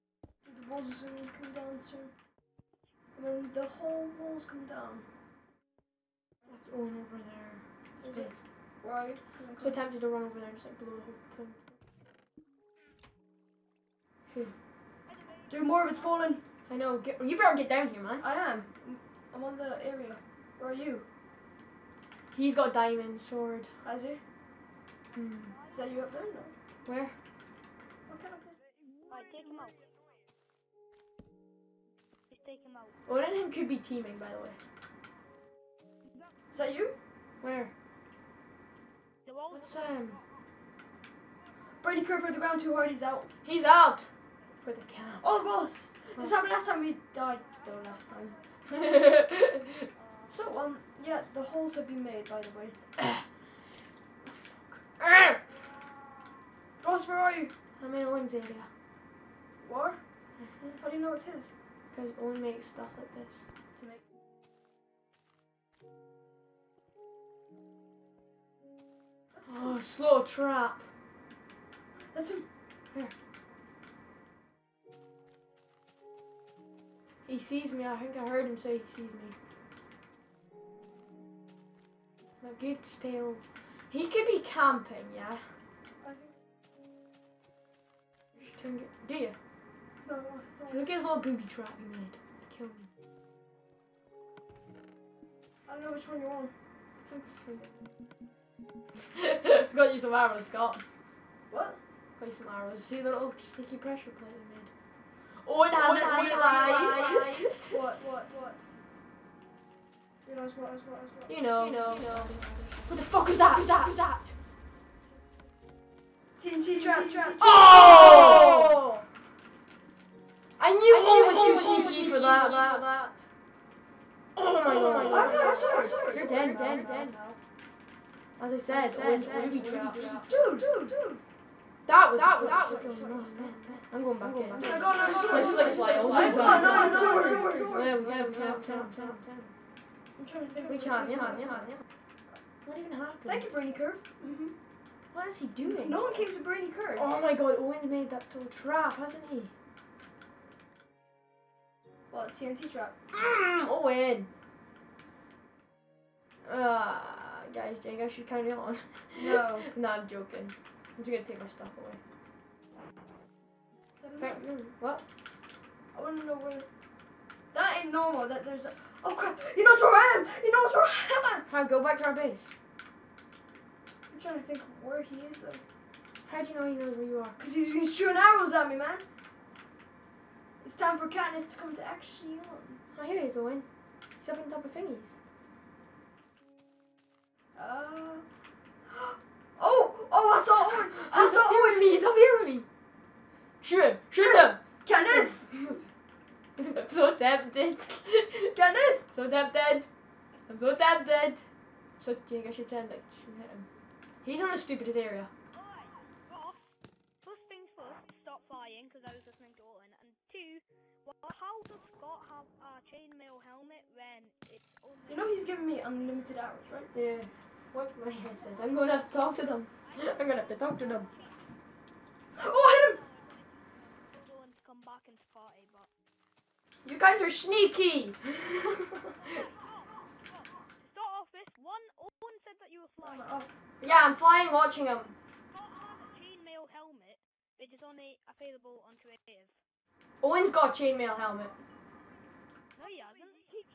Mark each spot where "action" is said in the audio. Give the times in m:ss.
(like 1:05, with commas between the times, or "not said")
3:01.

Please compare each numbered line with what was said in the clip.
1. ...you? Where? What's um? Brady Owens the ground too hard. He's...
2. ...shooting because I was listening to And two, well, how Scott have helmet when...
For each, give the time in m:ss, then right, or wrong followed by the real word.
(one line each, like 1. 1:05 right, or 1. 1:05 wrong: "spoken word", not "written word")
1. 0:36 wrong: "Kerr", not "Owens"
2. 3:28 wrong: "flying", not "shooting".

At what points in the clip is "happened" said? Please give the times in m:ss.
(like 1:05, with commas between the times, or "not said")
0:46, 2:22.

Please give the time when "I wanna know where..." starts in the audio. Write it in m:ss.
2:45.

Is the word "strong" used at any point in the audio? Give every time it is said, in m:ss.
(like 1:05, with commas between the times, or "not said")
2:12.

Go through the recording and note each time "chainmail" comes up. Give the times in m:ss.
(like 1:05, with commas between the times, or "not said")
3:55, 4:00.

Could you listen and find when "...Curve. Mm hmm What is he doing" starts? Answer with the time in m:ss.
2:23.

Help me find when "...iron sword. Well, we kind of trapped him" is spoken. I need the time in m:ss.
2:16.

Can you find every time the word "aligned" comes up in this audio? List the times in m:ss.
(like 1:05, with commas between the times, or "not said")
not said.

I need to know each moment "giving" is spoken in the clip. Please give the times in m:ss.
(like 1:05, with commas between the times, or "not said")
3:35.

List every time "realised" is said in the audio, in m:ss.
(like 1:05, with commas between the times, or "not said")
1:46, 1:50.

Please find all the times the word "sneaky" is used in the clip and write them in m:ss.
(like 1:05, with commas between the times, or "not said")
1:43, 2:01, 3:47.